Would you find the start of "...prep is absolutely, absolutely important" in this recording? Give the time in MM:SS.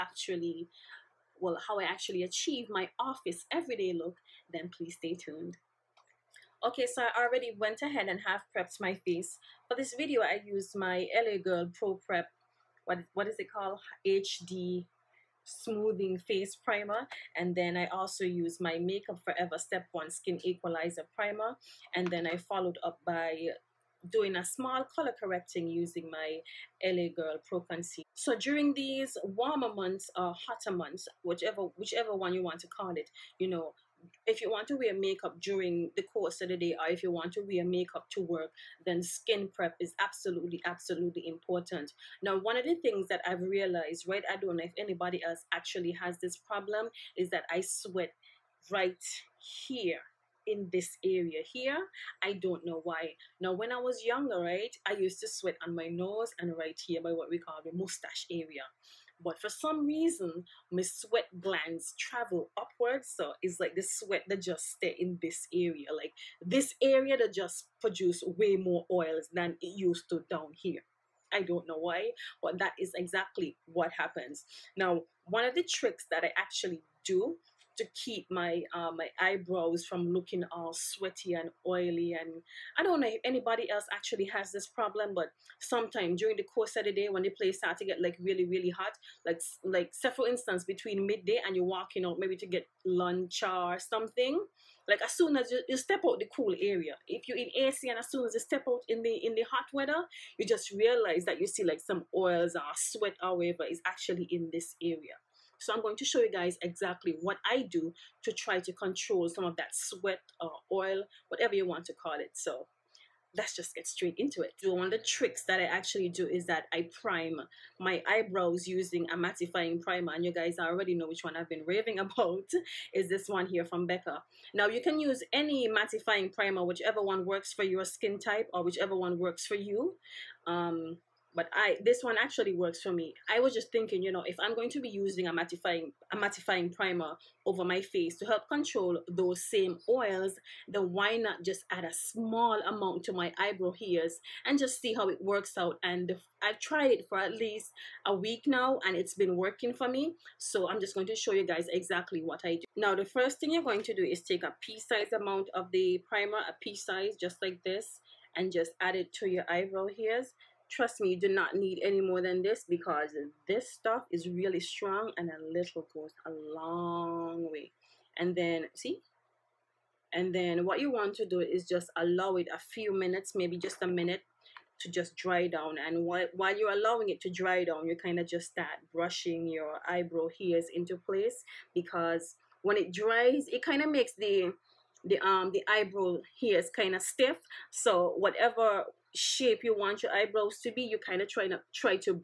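00:39.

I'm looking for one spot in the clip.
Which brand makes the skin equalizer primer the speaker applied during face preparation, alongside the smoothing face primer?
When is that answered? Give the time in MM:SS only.
00:18.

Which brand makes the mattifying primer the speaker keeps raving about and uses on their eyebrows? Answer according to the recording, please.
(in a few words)
Becca.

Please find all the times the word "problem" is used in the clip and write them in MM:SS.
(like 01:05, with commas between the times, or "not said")
00:46, 01:24.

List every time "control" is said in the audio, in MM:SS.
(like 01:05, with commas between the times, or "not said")
01:48, 02:18.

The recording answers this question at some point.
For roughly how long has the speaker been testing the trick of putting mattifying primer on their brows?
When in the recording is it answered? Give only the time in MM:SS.
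02:28.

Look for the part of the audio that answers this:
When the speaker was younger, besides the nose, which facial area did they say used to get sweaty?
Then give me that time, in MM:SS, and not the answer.
00:57.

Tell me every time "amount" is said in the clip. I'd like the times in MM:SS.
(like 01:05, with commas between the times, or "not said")
02:22, 02:35.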